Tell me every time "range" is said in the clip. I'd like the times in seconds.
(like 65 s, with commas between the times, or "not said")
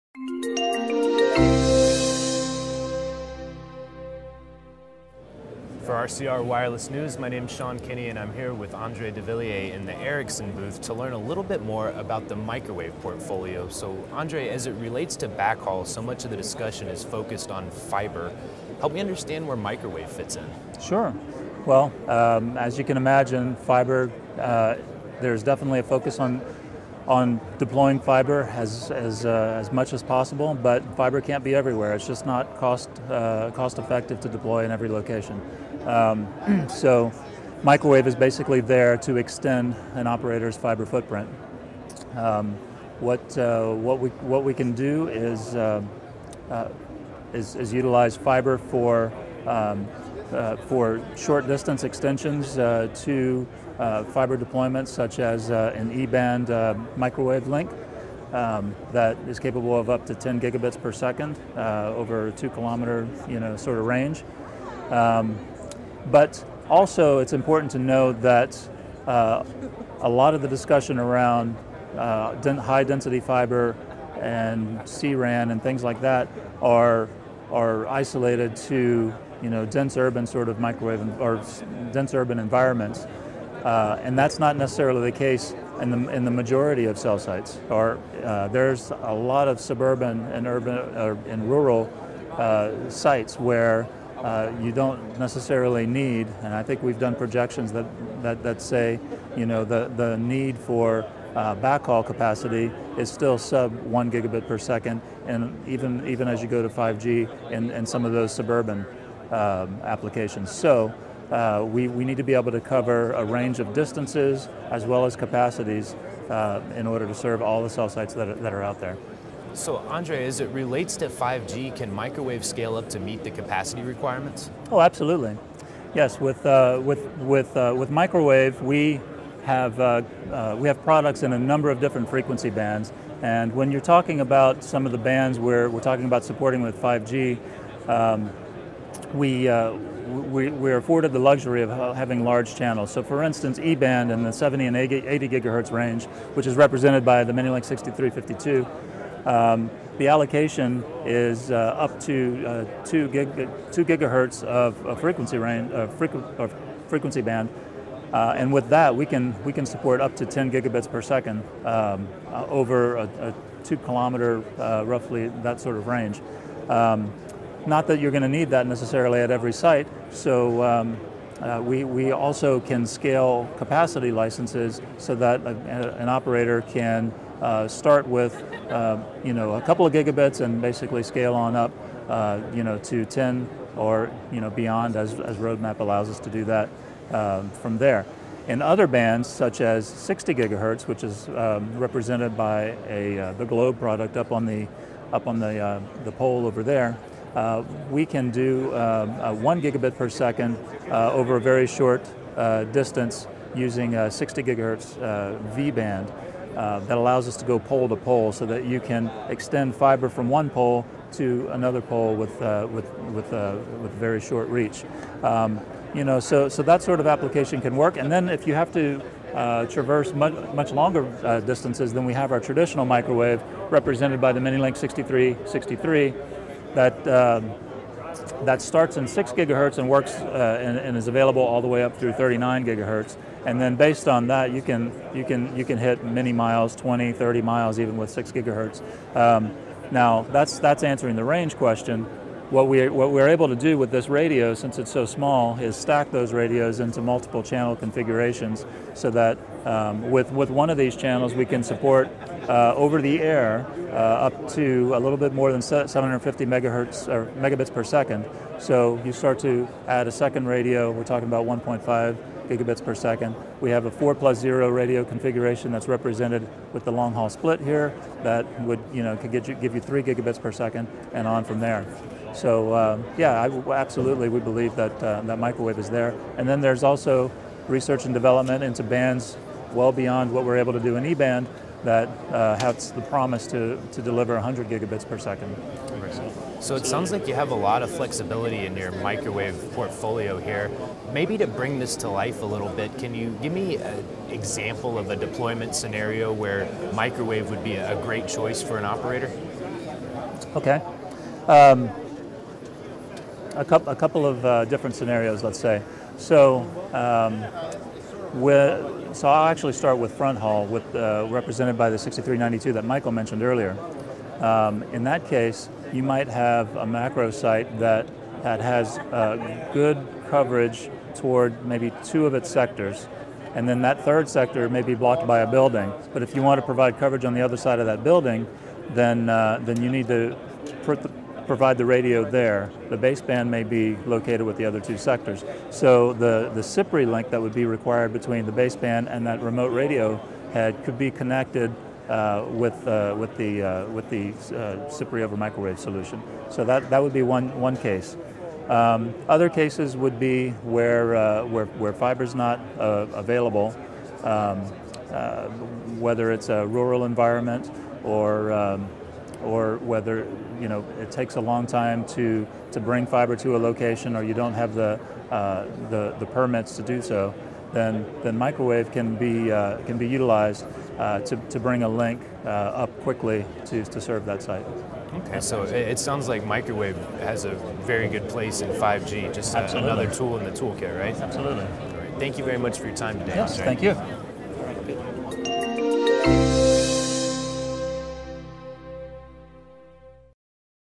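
63 s, 113 s, 145 s, 155 s, 165 s, 241 s.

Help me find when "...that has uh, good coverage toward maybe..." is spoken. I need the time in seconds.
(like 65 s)
318 s.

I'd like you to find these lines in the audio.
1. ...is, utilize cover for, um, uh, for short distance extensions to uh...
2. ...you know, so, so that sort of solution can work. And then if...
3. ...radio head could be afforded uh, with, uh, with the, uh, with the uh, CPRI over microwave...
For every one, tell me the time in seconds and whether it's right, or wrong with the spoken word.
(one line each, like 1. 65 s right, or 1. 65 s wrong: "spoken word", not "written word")
1. 47 s wrong: "fiber", not "cover"
2. 215 s wrong: "application", not "solution"
3. 339 s wrong: "connected", not "afforded".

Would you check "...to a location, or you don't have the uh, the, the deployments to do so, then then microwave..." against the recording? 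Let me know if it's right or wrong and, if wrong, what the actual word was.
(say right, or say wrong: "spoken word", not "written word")
wrong: "permits", not "deployments".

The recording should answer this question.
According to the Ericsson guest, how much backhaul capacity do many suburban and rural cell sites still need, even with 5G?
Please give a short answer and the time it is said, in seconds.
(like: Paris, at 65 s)
sub 1 gigabit per second, at 103 s.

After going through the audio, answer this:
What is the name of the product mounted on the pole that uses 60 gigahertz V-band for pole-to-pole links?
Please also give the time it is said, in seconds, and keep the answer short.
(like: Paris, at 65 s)
Globe, at 193 s.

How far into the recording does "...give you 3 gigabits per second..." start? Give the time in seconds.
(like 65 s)
269 s.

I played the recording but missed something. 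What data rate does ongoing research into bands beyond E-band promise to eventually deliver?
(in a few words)
100 gigabits per second.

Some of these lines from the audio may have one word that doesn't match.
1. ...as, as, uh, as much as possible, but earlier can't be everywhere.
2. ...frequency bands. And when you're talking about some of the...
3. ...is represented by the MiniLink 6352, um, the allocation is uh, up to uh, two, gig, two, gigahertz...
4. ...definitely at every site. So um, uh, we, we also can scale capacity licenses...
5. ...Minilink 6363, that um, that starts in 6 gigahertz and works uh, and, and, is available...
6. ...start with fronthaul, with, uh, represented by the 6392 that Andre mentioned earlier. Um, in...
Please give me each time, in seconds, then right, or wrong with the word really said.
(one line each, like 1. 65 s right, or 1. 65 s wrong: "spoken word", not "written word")
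1. 28 s wrong: "fiber", not "earlier"
2. 132 s right
3. 146 s right
4. 168 s wrong: "necessarily", not "definitely"
5. 224 s right
6. 309 s wrong: "Michael", not "Andre".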